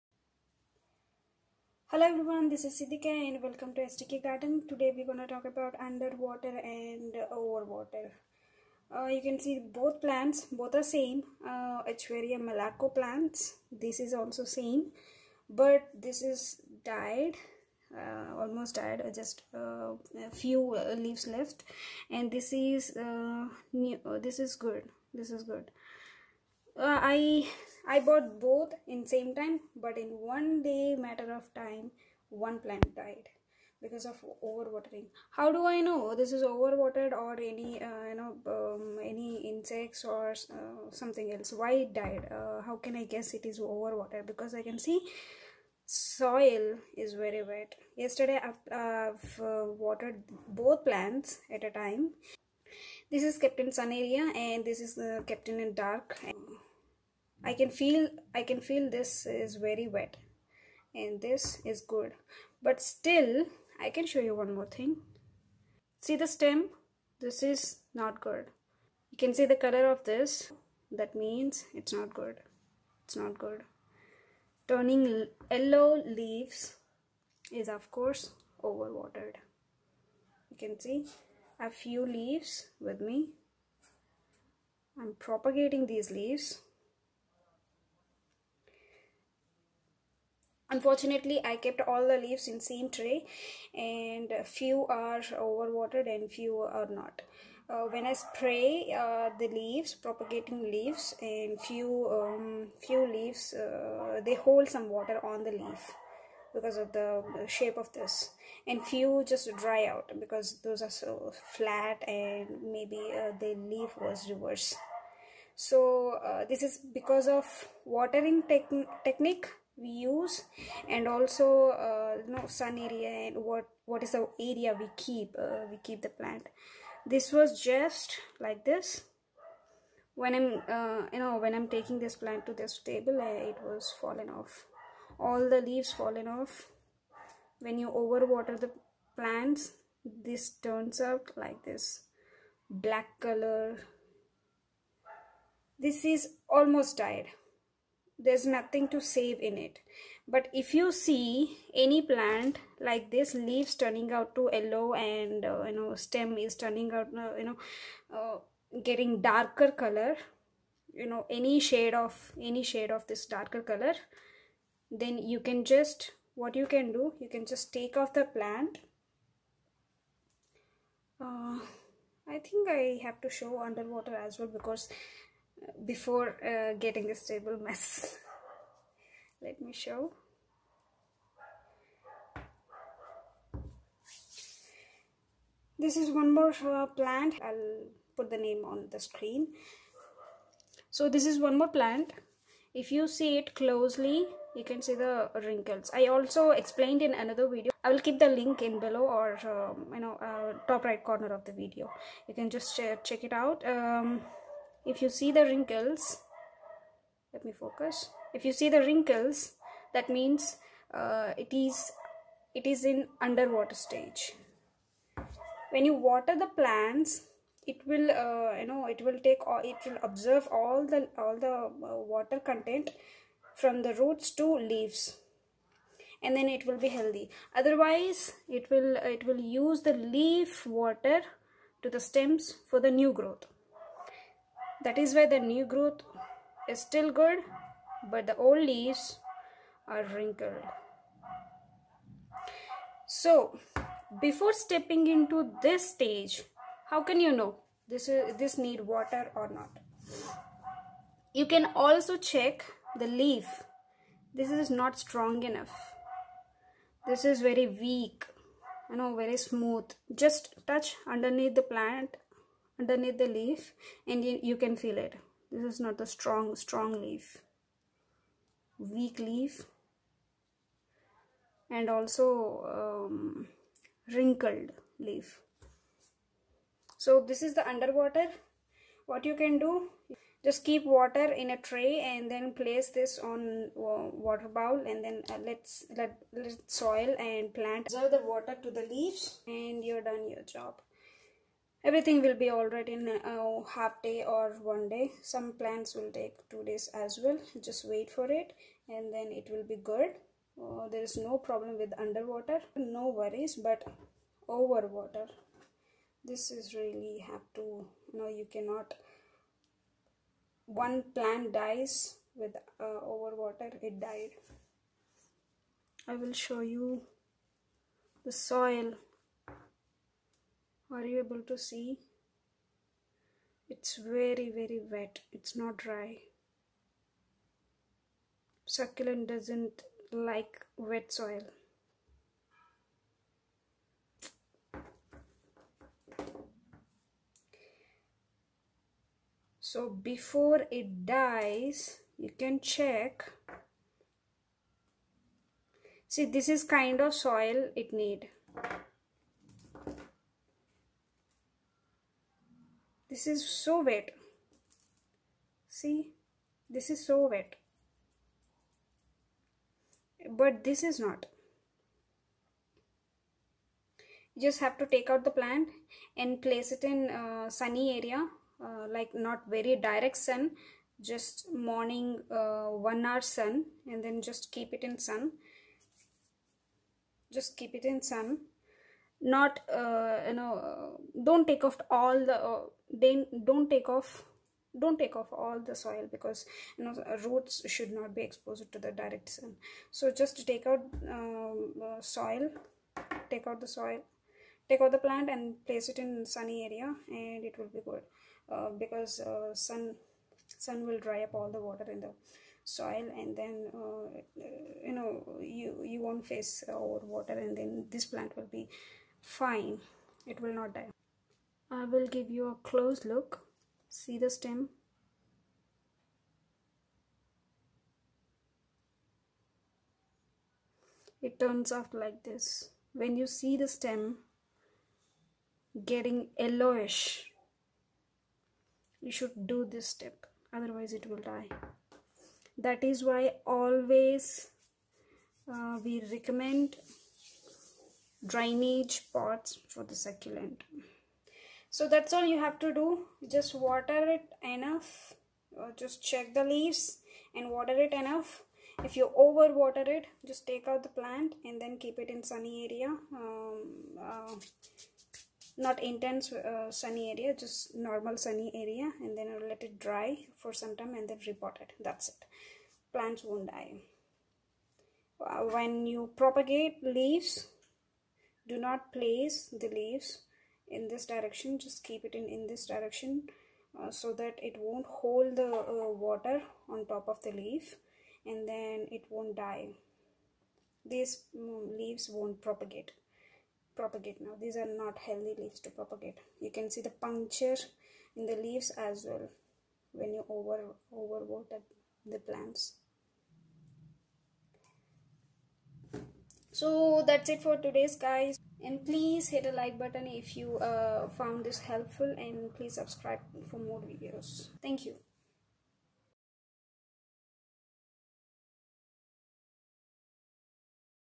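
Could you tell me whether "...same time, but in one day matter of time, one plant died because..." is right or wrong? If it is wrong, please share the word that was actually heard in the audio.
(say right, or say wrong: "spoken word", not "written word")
right.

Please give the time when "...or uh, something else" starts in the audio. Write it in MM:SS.
00:40.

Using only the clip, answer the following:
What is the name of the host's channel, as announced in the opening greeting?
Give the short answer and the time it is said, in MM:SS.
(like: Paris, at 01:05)
SDK garden, at 00:03.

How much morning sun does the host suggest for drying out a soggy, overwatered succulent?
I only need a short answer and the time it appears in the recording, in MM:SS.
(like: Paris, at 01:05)
one hour, at 06:12.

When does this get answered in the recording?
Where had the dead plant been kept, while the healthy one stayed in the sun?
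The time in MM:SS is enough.
00:55.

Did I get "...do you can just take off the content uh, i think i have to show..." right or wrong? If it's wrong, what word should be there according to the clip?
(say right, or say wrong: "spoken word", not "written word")
wrong: "plant", not "content".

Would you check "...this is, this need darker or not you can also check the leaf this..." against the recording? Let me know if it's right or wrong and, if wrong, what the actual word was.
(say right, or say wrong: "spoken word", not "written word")
wrong: "water", not "darker".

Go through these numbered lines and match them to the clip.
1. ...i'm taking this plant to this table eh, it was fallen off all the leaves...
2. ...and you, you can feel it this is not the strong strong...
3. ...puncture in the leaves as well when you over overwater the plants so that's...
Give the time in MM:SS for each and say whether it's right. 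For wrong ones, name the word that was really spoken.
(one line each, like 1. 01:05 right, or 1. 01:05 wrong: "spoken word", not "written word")
1. 02:11 right
2. 04:24 right
3. 08:07 right.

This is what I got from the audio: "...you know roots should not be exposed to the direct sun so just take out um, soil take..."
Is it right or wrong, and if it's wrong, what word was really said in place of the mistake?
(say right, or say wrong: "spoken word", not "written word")
right.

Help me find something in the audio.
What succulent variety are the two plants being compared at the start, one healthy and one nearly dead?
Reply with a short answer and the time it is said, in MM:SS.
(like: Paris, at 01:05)
Echeveria malaco, at 00:11.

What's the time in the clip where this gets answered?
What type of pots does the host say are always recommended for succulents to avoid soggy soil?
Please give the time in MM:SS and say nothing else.
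07:18.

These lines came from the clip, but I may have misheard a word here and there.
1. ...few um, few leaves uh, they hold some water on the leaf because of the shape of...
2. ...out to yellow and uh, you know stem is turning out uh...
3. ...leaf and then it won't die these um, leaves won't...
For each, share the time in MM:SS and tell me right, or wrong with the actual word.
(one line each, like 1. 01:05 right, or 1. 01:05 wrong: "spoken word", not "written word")
1. 01:41 right
2. 02:34 right
3. 07:57 right.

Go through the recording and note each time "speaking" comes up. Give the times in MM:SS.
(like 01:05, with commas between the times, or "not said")
not said.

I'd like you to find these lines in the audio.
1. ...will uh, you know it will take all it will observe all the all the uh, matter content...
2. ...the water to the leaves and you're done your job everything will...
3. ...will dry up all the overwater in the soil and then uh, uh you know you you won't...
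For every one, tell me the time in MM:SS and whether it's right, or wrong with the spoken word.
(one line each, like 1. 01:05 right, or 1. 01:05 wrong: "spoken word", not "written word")
1. 03:37 wrong: "water", not "matter"
2. 04:48 right
3. 06:40 wrong: "water", not "overwater".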